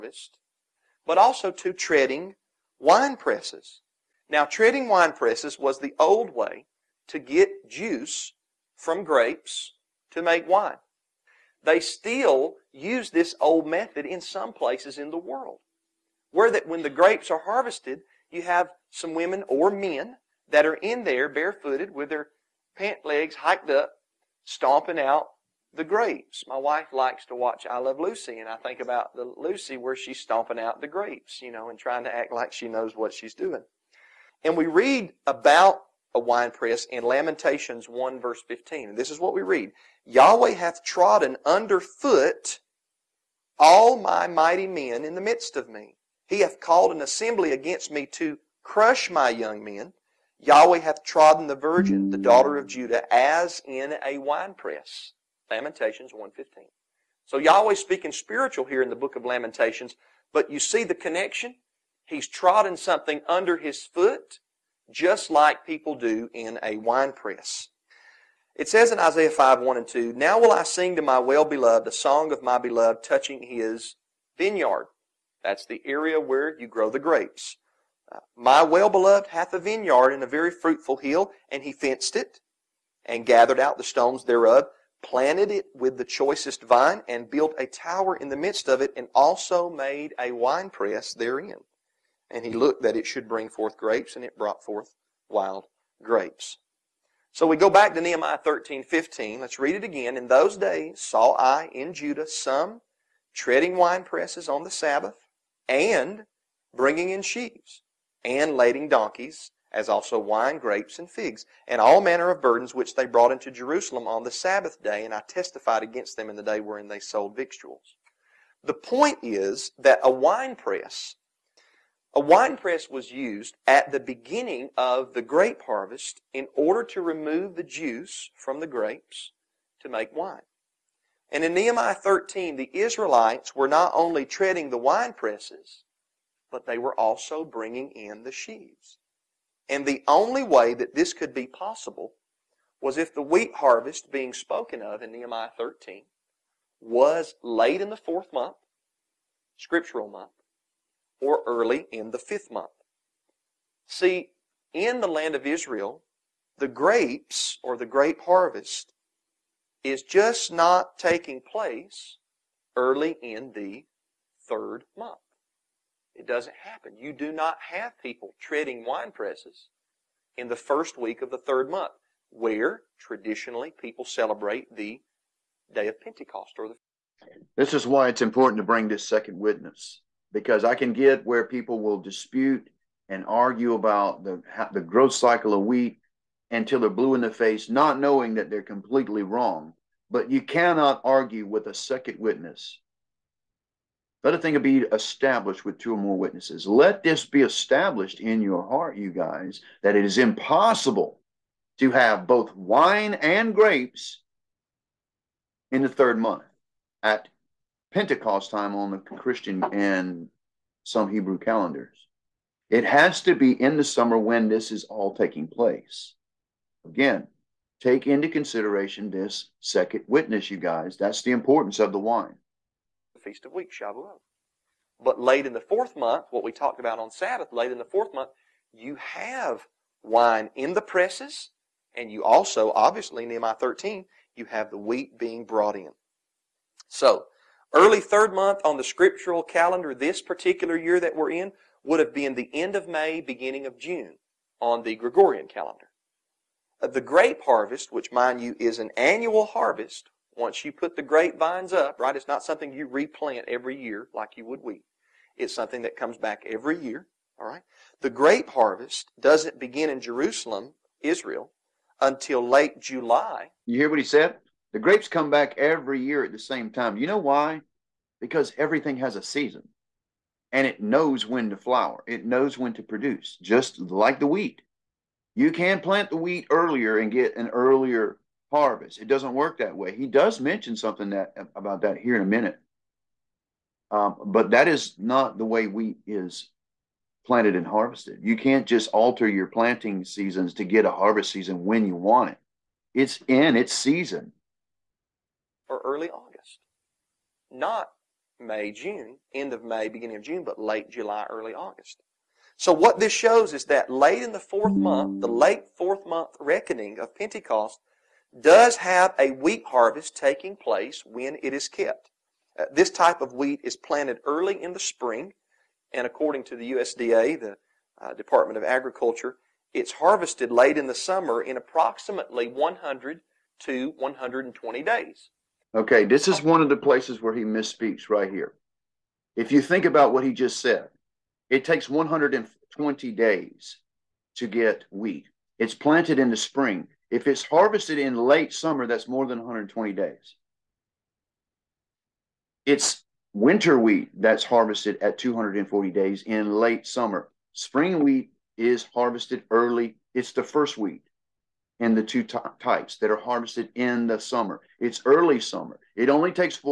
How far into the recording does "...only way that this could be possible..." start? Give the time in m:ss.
2:20.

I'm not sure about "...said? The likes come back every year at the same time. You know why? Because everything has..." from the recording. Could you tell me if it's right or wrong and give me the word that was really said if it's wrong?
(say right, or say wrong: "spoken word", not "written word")
wrong: "grapes", not "likes".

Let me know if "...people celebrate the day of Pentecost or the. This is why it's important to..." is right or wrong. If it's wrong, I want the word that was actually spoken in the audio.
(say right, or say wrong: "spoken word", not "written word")
right.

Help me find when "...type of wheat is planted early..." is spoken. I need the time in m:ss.
5:12.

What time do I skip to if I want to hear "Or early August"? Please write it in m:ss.
4:55.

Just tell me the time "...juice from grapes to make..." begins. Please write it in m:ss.
0:07.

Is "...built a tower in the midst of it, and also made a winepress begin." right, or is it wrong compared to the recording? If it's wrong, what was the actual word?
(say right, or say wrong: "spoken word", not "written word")
wrong: "therein", not "begin".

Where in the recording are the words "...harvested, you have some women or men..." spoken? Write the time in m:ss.
0:17.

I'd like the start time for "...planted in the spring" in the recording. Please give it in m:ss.
5:35.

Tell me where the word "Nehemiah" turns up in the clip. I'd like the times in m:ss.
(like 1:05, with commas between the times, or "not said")
1:37, 2:11, 2:25, 3:53.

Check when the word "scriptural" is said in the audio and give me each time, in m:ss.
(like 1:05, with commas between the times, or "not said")
2:29, 3:58.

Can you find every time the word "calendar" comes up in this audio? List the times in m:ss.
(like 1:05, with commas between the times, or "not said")
3:31, 3:59, 4:05.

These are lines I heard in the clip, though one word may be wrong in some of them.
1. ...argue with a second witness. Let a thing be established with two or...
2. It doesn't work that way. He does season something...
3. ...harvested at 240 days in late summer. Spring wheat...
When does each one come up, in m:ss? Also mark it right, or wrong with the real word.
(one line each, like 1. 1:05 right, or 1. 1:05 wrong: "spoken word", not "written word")
1. 3:11 right
2. 4:38 wrong: "mention", not "season"
3. 5:44 right.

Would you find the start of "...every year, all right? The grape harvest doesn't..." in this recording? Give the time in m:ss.
4:16.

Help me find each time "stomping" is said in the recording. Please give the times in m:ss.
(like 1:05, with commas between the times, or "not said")
0:24, 0:30.